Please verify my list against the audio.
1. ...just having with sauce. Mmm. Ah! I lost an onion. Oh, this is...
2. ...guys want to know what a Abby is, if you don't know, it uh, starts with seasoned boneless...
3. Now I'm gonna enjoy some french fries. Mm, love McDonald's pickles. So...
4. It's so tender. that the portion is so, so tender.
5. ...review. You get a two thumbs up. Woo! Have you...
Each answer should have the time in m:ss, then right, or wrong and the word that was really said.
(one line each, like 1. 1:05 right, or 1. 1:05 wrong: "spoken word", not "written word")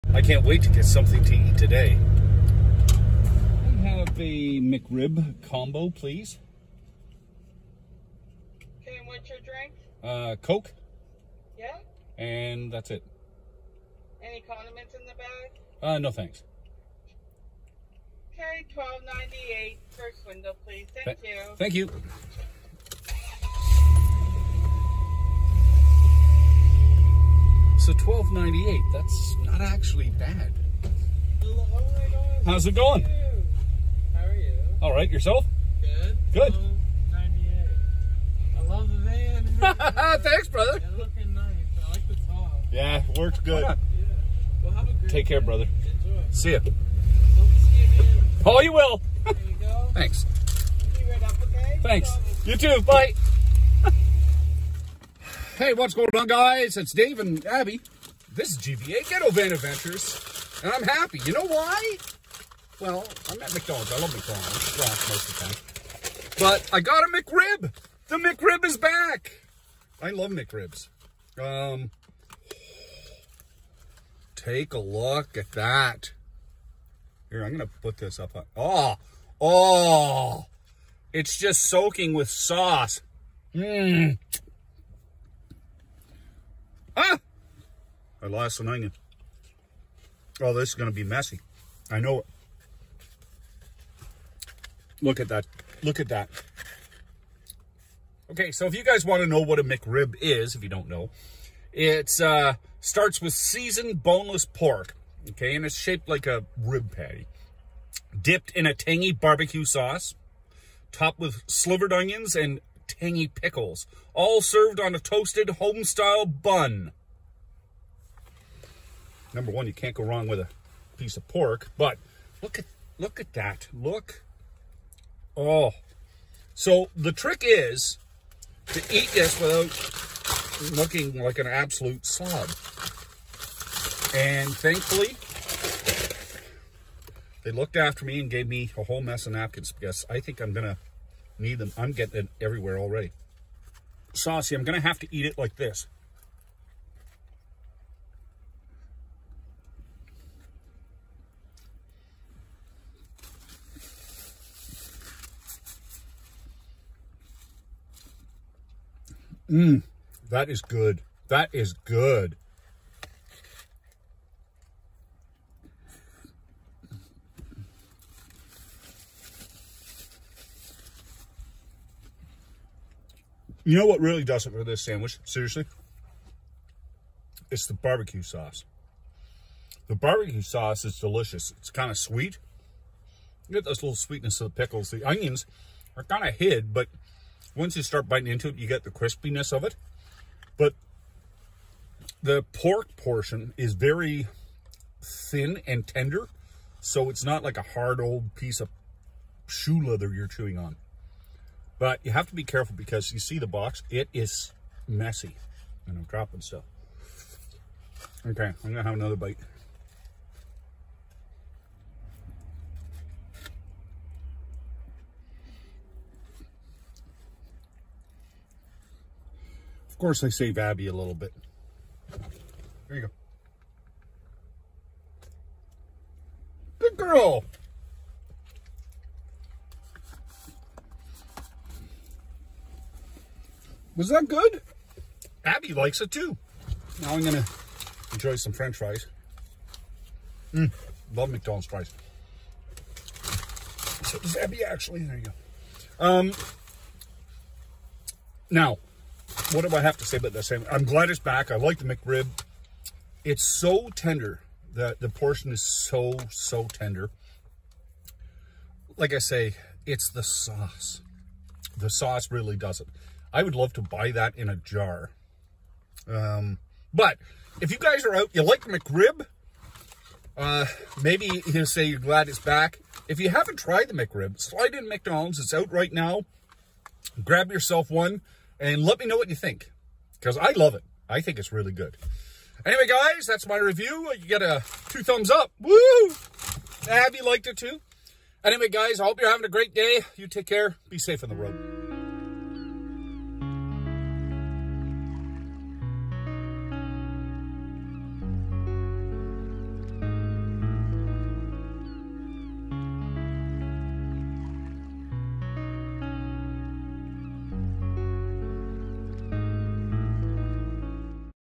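1. 1:21 wrong: "soaking", not "having"
2. 1:38 wrong: "McRib", not "Abby"
3. 3:57 wrong: "fries", not "pickles"
4. 4:13 right
5. 4:43 right.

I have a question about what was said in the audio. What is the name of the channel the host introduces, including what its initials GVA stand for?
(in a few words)
Ghetto Van Adventures.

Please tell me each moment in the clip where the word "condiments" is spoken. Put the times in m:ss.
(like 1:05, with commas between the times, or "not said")
0:14.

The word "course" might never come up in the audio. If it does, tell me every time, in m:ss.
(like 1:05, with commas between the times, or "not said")
3:39.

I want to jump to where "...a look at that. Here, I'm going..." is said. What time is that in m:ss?
1:14.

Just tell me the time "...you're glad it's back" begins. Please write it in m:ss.
4:31.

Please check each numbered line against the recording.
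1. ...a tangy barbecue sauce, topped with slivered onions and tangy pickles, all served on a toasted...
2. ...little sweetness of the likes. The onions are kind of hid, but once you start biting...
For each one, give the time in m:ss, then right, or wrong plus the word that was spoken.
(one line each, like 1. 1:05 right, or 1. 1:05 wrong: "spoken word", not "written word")
1. 1:48 right
2. 3:03 wrong: "pickles", not "likes".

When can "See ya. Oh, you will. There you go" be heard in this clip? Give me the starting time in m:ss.
0:46.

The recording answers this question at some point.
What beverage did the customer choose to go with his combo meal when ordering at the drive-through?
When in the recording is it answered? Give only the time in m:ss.
0:10.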